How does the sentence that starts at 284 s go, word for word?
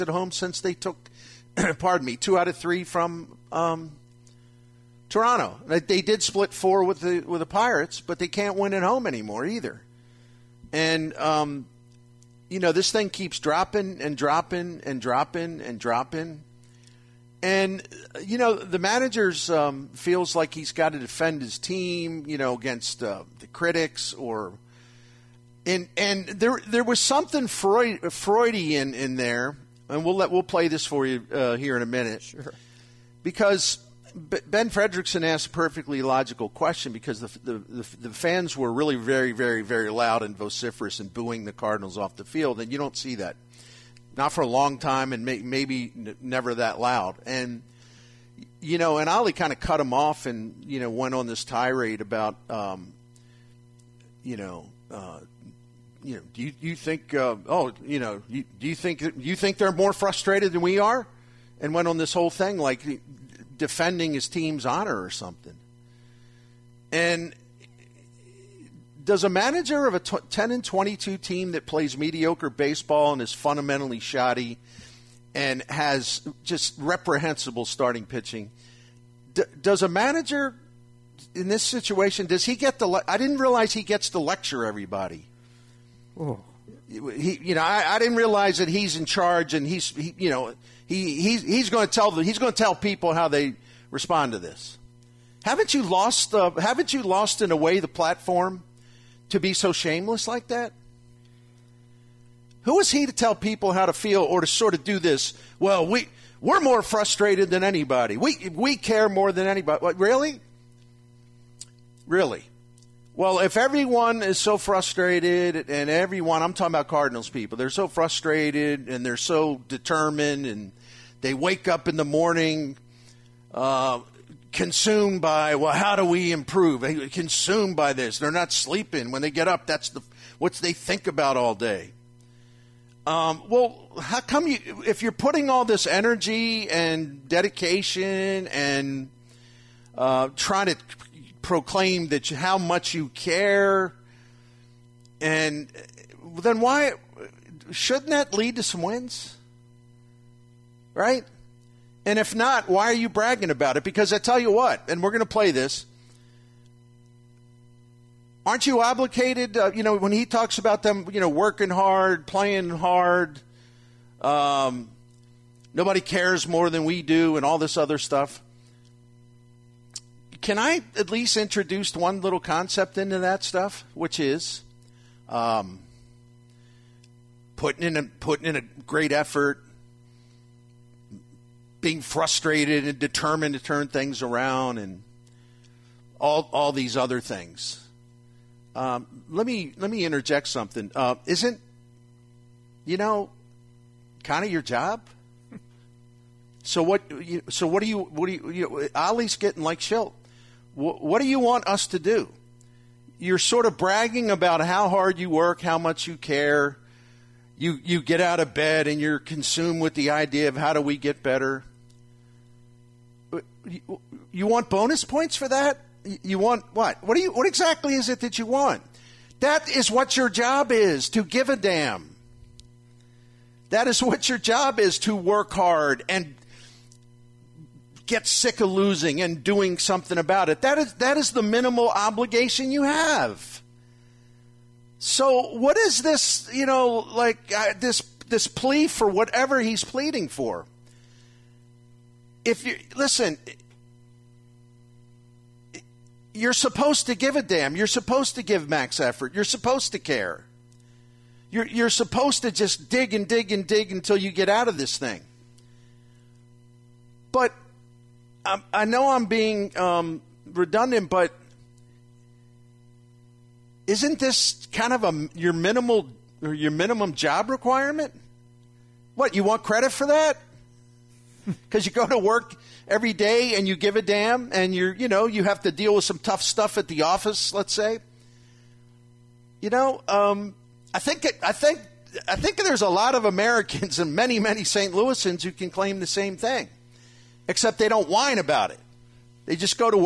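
Louisans who can claim the same thing except they don't whine about it.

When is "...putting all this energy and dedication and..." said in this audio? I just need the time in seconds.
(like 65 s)
135 s.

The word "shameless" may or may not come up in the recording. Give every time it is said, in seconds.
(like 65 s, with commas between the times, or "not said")
99 s.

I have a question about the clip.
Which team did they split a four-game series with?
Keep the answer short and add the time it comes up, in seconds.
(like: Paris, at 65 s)
Pirates, at 7 s.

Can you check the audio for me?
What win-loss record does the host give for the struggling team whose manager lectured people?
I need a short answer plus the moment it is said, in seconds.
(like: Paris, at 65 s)
10 and 22, at 70 s.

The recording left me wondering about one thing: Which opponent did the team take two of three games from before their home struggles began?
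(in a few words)
Toronto.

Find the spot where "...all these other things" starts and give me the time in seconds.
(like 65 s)
186 s.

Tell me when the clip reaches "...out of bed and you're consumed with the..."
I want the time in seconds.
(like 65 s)
208 s.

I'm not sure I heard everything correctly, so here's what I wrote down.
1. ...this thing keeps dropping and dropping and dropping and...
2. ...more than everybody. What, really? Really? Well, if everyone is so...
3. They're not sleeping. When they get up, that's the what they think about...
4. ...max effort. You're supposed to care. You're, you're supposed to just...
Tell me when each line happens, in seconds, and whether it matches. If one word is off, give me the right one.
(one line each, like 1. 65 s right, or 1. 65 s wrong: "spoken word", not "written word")
1. 12 s right
2. 109 s wrong: "anybody", not "everybody"
3. 128 s right
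4. 248 s right.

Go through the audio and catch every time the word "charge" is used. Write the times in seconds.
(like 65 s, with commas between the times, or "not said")
89 s.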